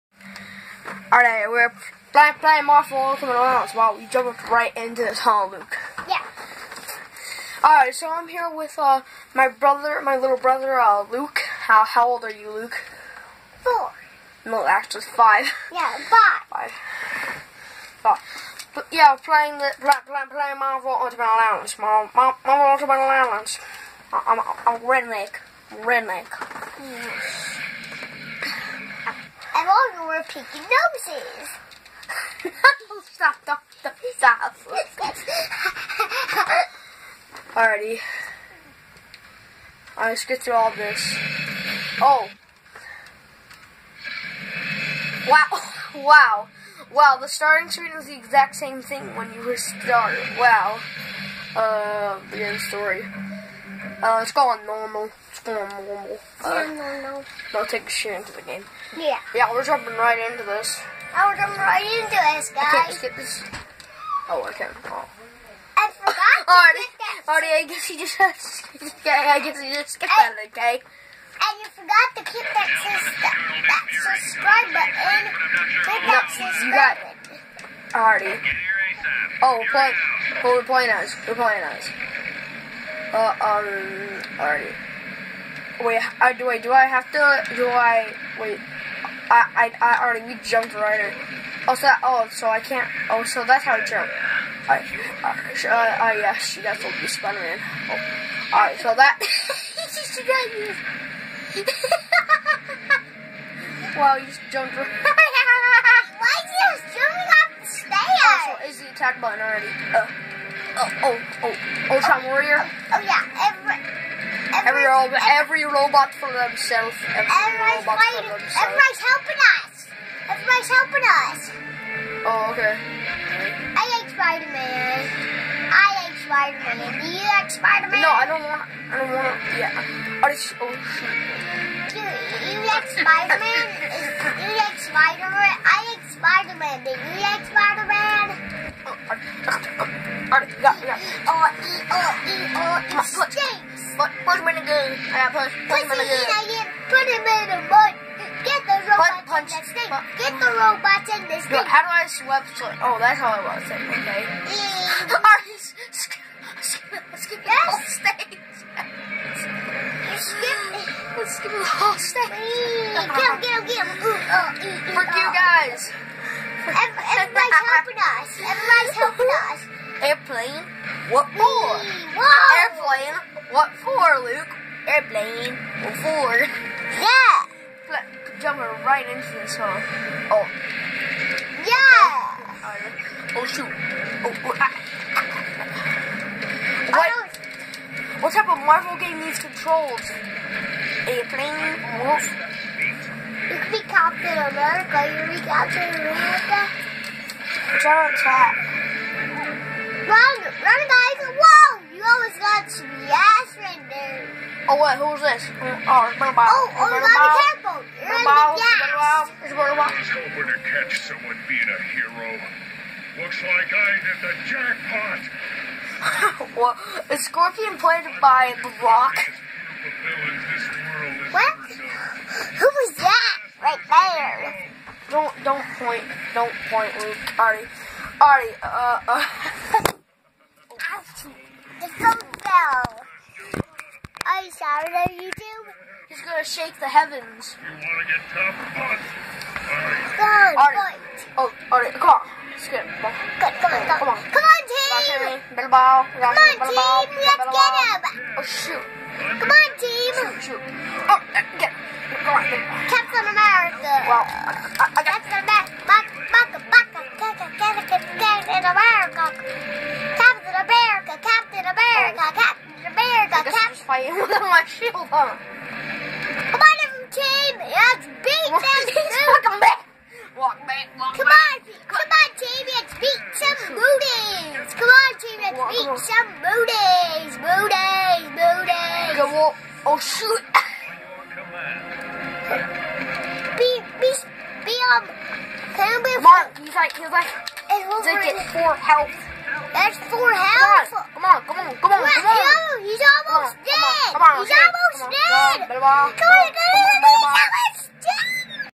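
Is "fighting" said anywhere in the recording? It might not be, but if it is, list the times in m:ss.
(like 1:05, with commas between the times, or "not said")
1:58, 4:23.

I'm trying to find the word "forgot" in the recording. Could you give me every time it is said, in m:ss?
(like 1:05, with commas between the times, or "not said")
1:05, 1:11.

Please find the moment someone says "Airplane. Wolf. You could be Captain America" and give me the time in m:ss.
3:11.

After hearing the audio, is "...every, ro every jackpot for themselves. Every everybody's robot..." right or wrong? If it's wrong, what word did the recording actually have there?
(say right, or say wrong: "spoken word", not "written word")
wrong: "robot", not "jackpot".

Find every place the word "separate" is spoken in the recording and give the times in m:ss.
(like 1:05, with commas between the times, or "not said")
not said.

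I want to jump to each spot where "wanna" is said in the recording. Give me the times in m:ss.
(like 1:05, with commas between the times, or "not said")
3:57.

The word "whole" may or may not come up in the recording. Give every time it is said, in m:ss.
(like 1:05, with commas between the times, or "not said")
2:37, 2:41.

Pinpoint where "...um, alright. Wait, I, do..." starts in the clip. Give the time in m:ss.
1:23.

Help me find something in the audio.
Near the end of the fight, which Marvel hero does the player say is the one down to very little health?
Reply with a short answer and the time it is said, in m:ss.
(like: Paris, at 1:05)
Wolverine, at 4:47.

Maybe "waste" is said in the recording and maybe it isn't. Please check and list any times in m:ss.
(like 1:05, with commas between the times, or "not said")
not said.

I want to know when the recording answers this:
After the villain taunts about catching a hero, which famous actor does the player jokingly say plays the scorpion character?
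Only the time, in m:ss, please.
3:38.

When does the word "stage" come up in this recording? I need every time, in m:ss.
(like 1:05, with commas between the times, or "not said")
2:37, 2:41.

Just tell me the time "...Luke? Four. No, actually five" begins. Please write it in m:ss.
0:12.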